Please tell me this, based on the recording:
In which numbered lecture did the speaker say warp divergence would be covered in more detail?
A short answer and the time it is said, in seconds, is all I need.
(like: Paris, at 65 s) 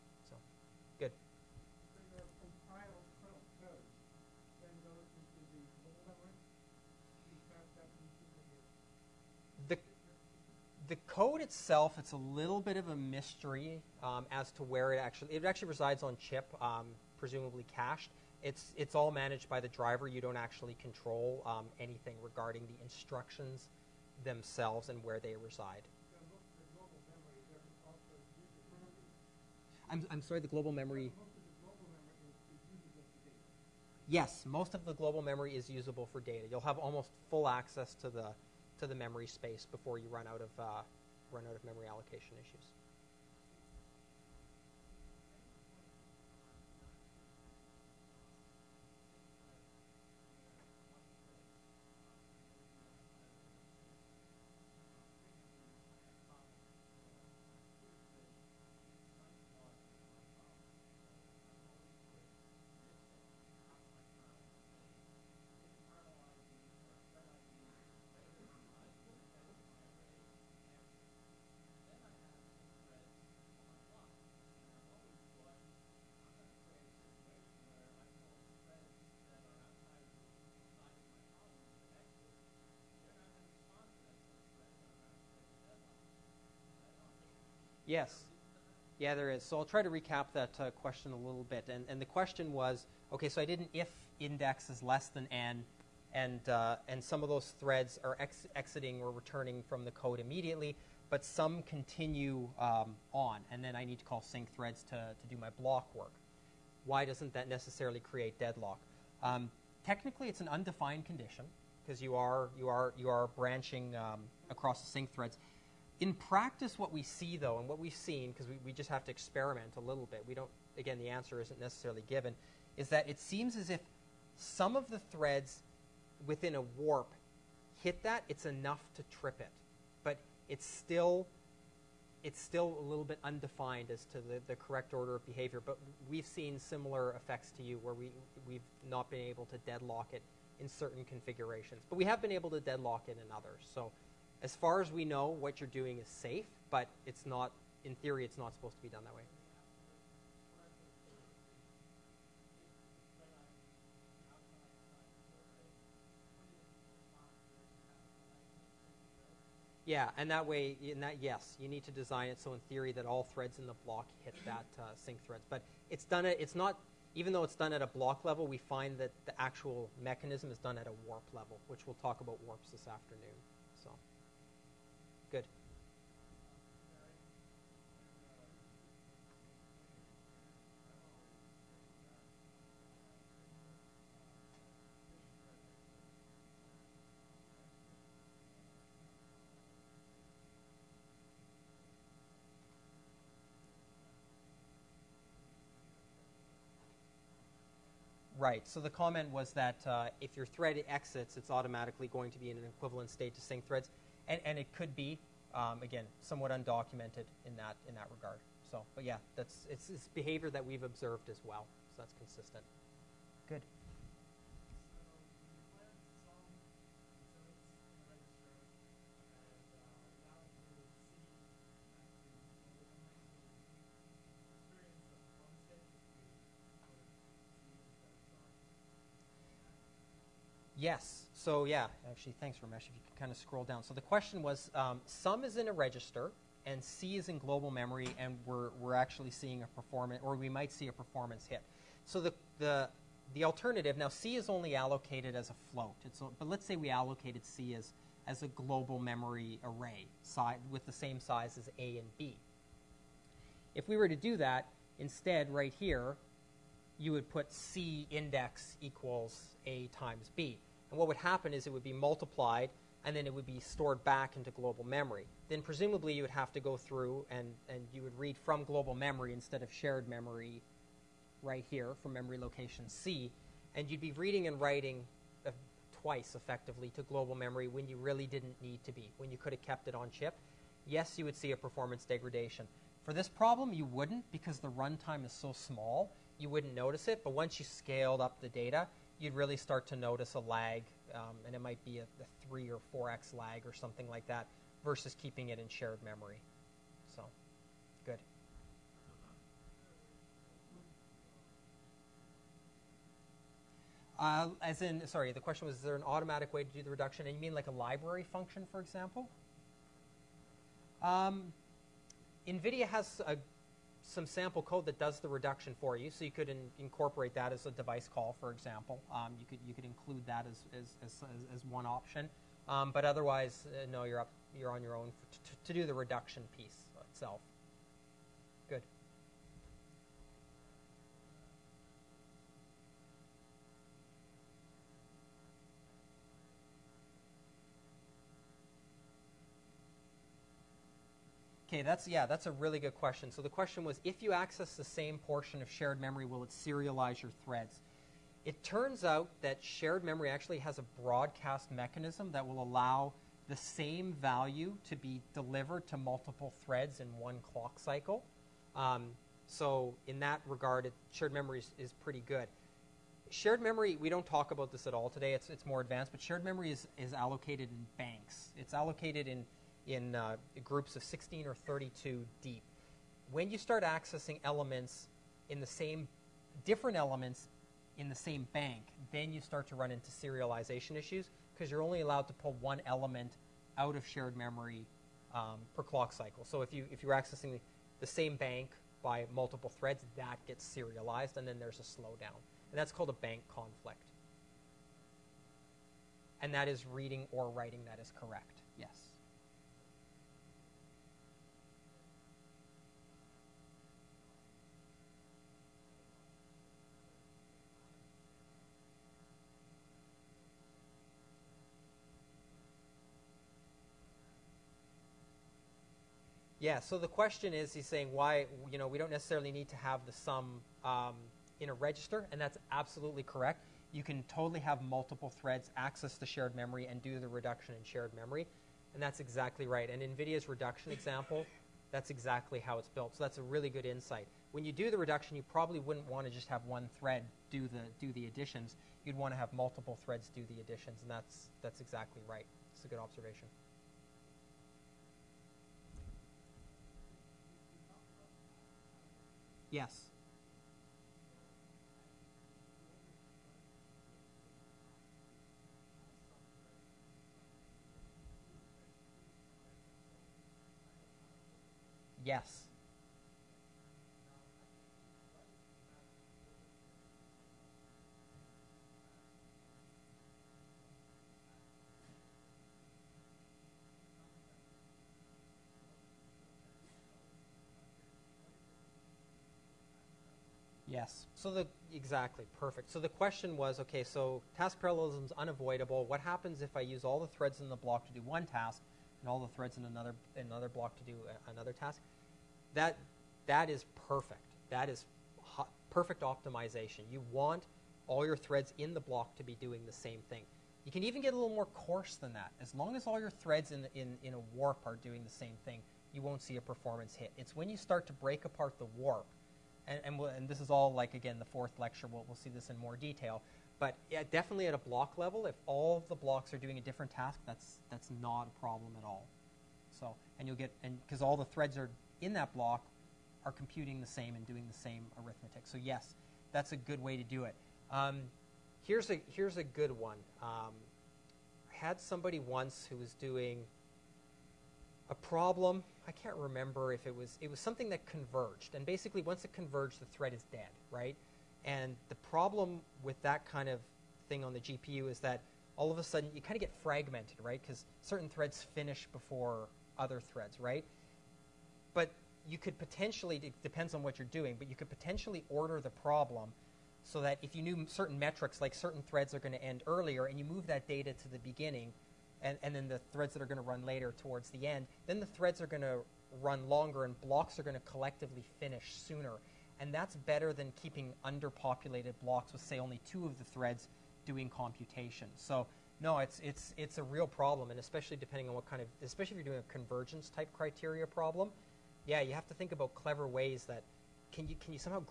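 Fourth, at 511 s.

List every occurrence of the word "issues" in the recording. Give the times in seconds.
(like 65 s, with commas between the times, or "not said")
42 s, 380 s.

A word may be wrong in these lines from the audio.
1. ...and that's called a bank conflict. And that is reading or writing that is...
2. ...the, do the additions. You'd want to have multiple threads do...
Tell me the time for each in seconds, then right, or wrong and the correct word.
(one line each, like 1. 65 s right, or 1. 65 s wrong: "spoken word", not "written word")
1. 392 s right
2. 437 s right.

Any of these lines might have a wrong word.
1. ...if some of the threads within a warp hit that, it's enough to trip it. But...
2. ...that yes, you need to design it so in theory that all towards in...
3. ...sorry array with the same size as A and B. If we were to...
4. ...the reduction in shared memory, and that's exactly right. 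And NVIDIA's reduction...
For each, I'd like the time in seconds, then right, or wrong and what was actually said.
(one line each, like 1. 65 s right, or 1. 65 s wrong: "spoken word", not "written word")
1. 123 s right
2. 160 s wrong: "threads", not "towards"
3. 248 s wrong: "memory", not "sorry"
4. 427 s right.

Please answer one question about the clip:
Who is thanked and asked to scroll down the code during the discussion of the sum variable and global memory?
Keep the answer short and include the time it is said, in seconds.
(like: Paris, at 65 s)
Ramesh, at 232 s.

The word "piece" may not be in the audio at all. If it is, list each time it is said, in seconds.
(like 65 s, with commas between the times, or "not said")
326 s.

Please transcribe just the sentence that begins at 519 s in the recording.
So, and you'll get, and because all the threads are in that block are computing the same and doing the same arithmetic.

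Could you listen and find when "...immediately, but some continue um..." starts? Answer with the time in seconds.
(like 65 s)
100 s.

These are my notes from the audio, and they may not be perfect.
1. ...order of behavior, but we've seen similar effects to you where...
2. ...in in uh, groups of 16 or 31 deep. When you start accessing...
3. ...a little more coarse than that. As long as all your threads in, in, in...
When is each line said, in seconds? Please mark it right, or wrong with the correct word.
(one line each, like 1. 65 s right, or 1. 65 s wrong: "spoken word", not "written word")
1. 134 s right
2. 369 s wrong: "32", not "31"
3. 501 s right.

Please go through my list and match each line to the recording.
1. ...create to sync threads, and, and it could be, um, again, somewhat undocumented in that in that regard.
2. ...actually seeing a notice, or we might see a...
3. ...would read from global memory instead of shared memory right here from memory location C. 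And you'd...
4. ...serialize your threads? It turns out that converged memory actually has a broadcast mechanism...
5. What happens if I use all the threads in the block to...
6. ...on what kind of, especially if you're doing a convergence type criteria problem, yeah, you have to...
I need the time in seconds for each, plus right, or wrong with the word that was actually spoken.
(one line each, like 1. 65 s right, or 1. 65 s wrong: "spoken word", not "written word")
1. 203 s wrong: "state", not "create"
2. 238 s wrong: "performance", not "notice"
3. 268 s right
4. 346 s wrong: "shared", not "converged"
5. 486 s right
6. 578 s right.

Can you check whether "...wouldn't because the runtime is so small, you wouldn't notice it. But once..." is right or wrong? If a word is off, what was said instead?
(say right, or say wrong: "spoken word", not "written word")
right.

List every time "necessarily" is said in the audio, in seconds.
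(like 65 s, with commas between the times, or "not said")
107 s, 121 s, 419 s.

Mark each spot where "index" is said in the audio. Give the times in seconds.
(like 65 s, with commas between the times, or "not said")
94 s, 258 s.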